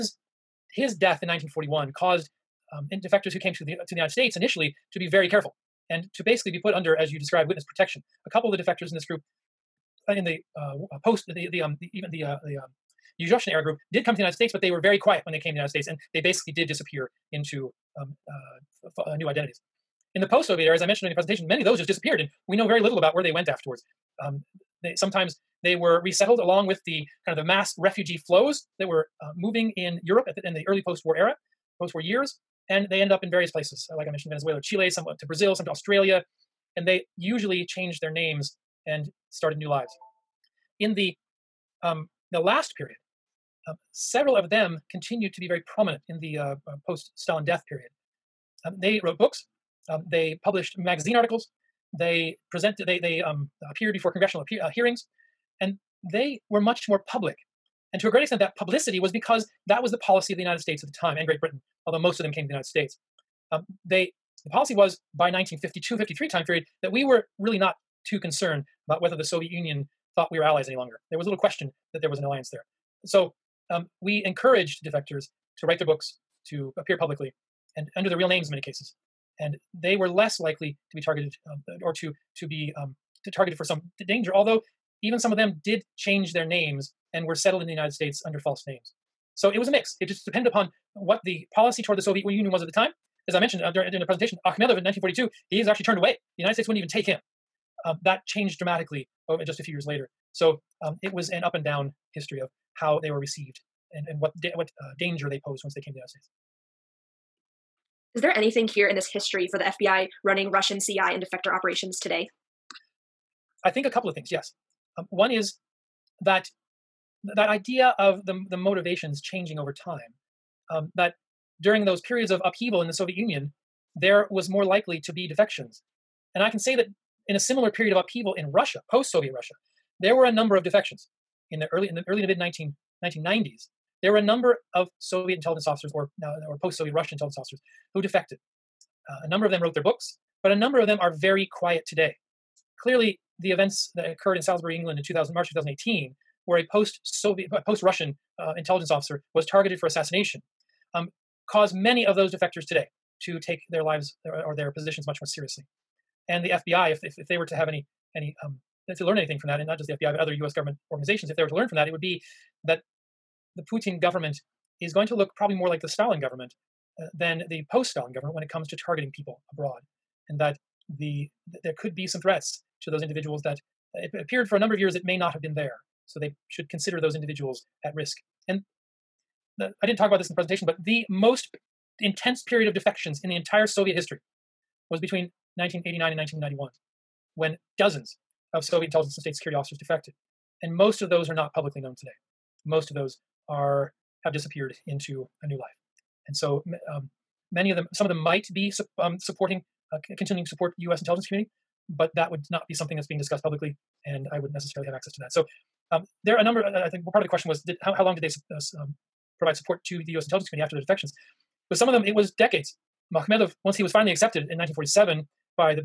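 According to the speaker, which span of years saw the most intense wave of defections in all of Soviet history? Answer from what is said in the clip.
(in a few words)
1989 to 1991.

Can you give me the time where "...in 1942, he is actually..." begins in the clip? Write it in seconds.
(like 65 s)
94 s.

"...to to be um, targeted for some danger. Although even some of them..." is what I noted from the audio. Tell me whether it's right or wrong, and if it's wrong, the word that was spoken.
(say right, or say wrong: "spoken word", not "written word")
right.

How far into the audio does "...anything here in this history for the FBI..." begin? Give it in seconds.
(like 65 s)
108 s.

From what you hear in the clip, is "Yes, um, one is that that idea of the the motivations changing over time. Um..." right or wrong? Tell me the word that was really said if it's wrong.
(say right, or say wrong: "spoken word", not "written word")
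right.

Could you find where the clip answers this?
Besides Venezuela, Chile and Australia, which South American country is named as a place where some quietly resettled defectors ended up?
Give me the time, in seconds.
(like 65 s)
35 s.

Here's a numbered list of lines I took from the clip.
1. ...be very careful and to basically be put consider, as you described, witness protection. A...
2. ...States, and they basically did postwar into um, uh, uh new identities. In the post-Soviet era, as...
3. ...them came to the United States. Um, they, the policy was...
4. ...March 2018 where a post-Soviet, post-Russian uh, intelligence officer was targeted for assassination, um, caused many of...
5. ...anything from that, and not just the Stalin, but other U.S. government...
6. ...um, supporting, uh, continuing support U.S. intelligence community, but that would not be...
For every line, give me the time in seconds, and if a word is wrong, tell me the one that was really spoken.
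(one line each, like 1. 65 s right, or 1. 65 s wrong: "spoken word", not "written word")
1. 4 s wrong: "under", not "consider"
2. 15 s wrong: "disappear", not "postwar"
3. 62 s right
4. 145 s right
5. 159 s wrong: "FBI", not "Stalin"
6. 198 s right.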